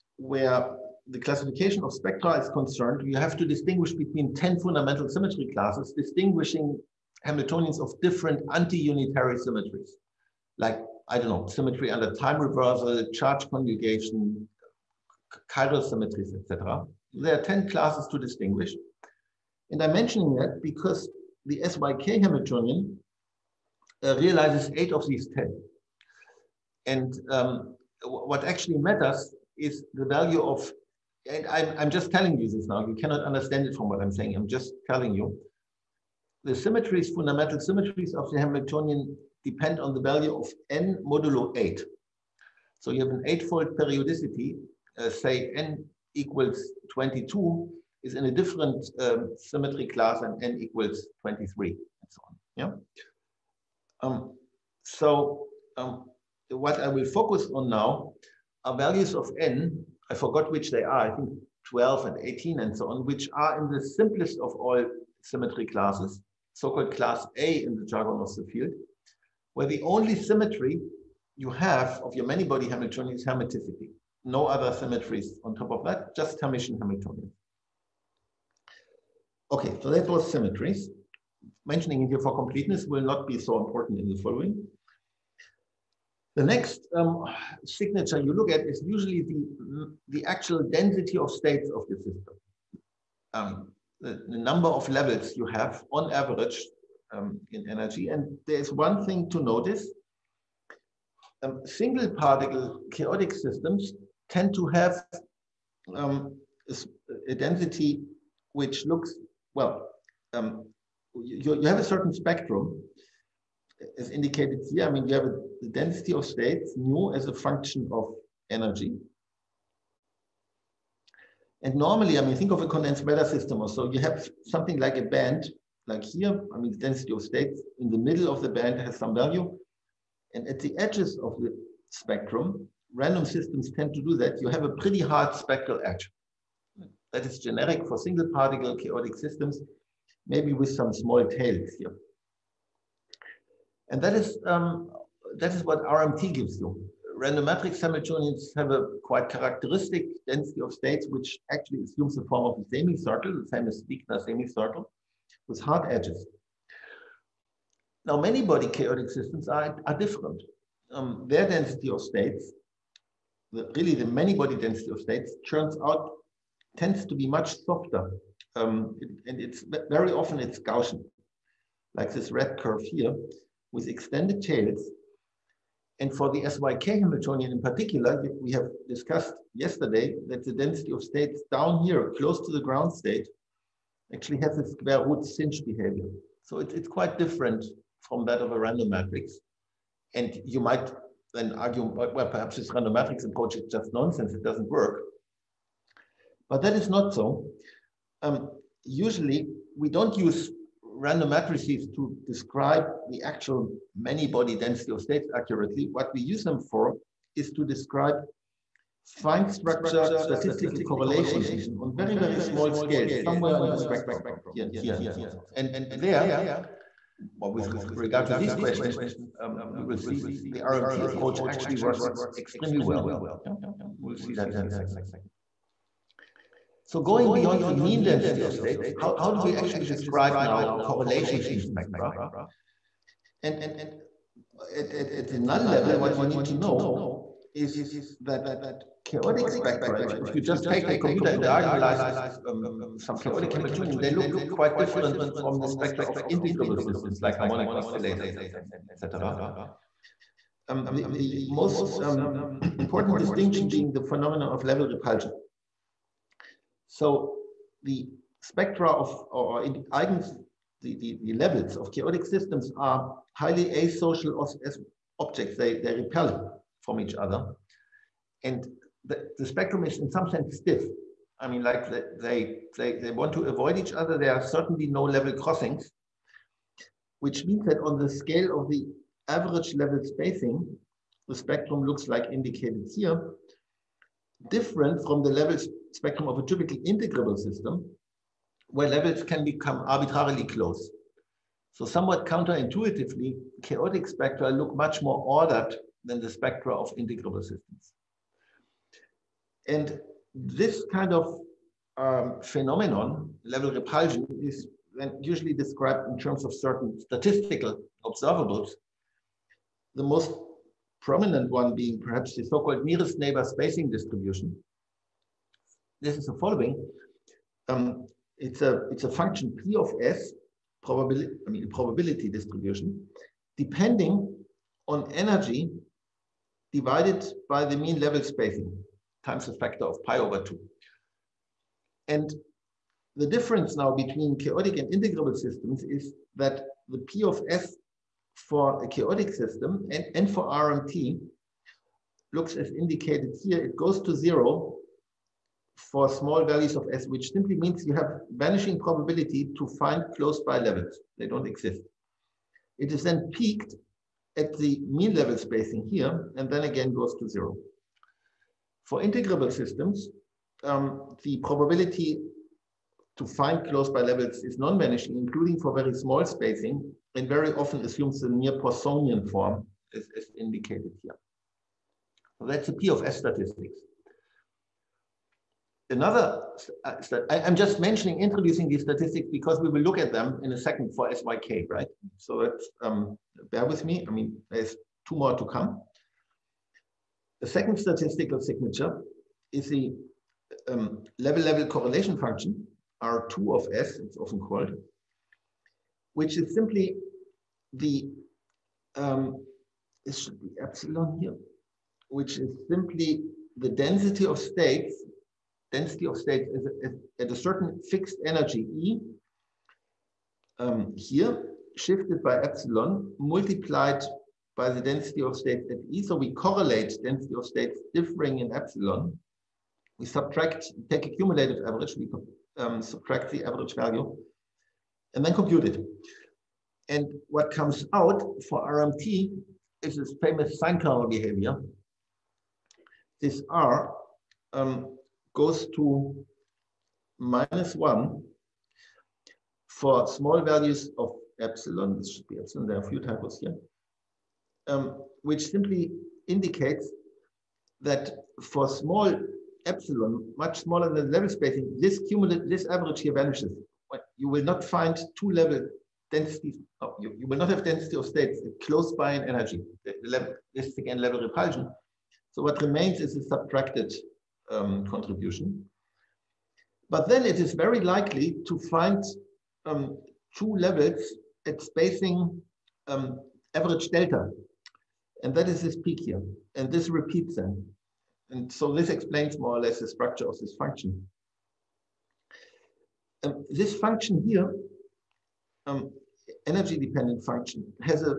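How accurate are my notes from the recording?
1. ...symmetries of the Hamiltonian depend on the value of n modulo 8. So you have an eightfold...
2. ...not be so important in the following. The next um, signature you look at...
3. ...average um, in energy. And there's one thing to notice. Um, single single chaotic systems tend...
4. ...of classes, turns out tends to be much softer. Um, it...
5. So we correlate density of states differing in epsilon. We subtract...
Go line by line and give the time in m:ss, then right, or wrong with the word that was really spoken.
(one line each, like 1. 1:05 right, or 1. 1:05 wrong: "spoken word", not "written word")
1. 0:37 right
2. 1:23 right
3. 1:36 wrong: "particle", not "single"
4. 2:44 wrong: "states", not "classes"
5. 6:56 right.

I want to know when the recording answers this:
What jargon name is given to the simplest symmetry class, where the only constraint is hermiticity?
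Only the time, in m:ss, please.
1:06.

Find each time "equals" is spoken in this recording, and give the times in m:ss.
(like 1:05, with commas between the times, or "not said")
0:46, 0:50.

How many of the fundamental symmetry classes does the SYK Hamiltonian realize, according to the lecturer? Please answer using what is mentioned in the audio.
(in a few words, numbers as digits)
8.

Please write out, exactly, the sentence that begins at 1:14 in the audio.
No other symmetries on top of that, just Hermitian Hamiltonian.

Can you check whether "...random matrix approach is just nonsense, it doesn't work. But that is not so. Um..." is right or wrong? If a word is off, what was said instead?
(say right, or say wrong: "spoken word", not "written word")
right.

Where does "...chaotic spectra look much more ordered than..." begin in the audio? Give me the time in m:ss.
4:53.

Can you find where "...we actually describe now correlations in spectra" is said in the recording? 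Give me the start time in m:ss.
3:49.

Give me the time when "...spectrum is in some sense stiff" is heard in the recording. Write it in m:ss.
4:29.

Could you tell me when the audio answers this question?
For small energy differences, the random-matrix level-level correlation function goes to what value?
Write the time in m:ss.
7:17.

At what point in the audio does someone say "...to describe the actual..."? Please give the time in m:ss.
3:21.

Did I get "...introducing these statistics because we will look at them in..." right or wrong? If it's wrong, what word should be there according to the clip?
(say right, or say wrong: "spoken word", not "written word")
right.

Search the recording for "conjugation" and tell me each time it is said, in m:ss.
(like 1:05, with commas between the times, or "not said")
0:13.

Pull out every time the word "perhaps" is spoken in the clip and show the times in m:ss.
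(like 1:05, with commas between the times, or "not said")
3:12, 5:11.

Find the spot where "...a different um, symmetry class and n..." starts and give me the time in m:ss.
0:48.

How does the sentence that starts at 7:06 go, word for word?
And what comes out for RMT is this famous sine curve behavior.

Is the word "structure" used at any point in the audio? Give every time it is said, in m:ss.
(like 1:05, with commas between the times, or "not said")
3:29, 7:59.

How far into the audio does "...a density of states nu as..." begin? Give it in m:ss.
1:55.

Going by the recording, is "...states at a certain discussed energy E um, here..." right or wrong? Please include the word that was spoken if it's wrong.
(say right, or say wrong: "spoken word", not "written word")
wrong: "fixed", not "discussed".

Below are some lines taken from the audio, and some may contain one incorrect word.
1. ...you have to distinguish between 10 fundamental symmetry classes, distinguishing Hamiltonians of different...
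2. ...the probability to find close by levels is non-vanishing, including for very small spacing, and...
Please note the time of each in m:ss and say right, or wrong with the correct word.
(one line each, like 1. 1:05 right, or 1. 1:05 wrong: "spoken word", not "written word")
1. 0:03 right
2. 6:01 right.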